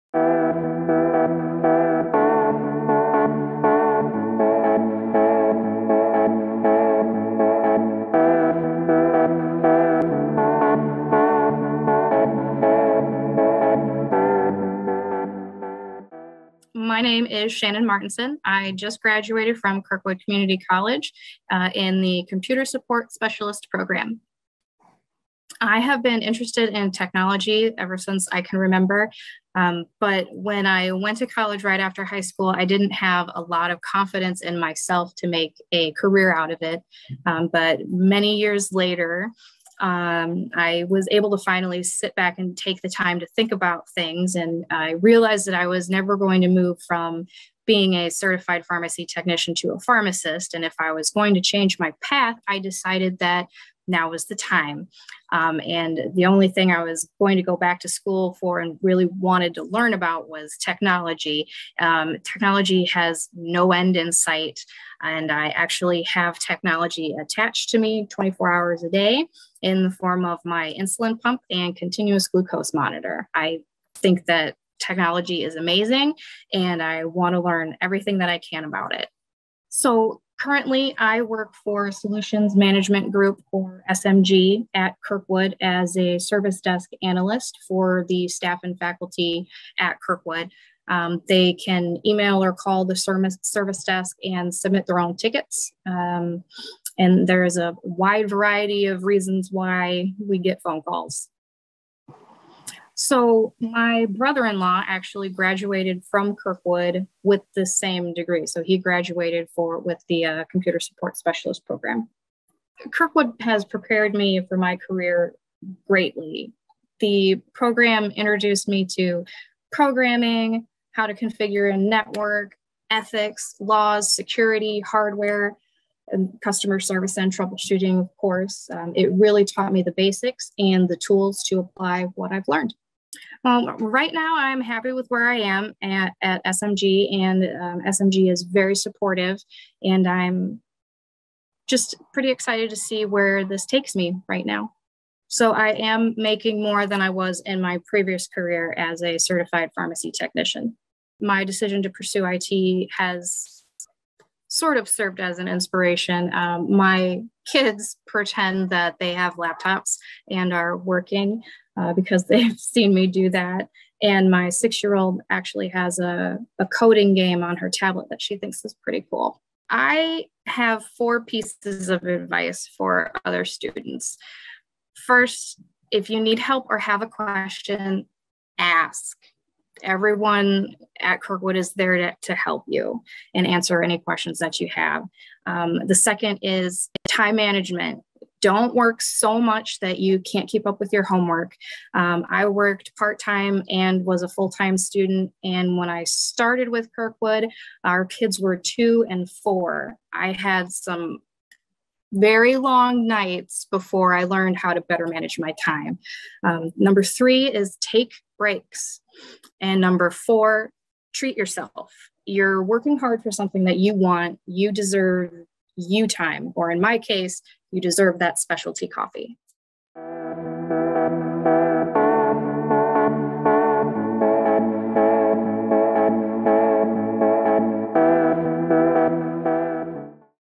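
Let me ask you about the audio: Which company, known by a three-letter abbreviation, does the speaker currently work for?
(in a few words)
Solutions Management Group.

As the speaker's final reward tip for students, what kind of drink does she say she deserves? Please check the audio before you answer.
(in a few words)
specialty coffee.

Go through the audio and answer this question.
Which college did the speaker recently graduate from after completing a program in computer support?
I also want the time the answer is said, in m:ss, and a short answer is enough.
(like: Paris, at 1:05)
Kirkwood Community College, at 0:19.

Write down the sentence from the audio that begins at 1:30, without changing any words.
Um, they can email or call the service, service desk and submit their own tickets.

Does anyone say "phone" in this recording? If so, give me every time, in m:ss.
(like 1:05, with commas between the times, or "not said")
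1:40.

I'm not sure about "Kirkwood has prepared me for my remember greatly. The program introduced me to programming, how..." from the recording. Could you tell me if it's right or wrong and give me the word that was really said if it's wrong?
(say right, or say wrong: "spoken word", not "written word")
wrong: "career", not "remember".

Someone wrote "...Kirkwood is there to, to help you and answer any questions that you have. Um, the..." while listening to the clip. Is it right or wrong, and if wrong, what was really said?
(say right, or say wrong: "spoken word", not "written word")
right.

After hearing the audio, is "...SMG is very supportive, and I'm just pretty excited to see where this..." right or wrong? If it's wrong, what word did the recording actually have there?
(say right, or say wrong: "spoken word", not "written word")
right.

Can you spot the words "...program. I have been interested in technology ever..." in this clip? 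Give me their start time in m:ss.
0:23.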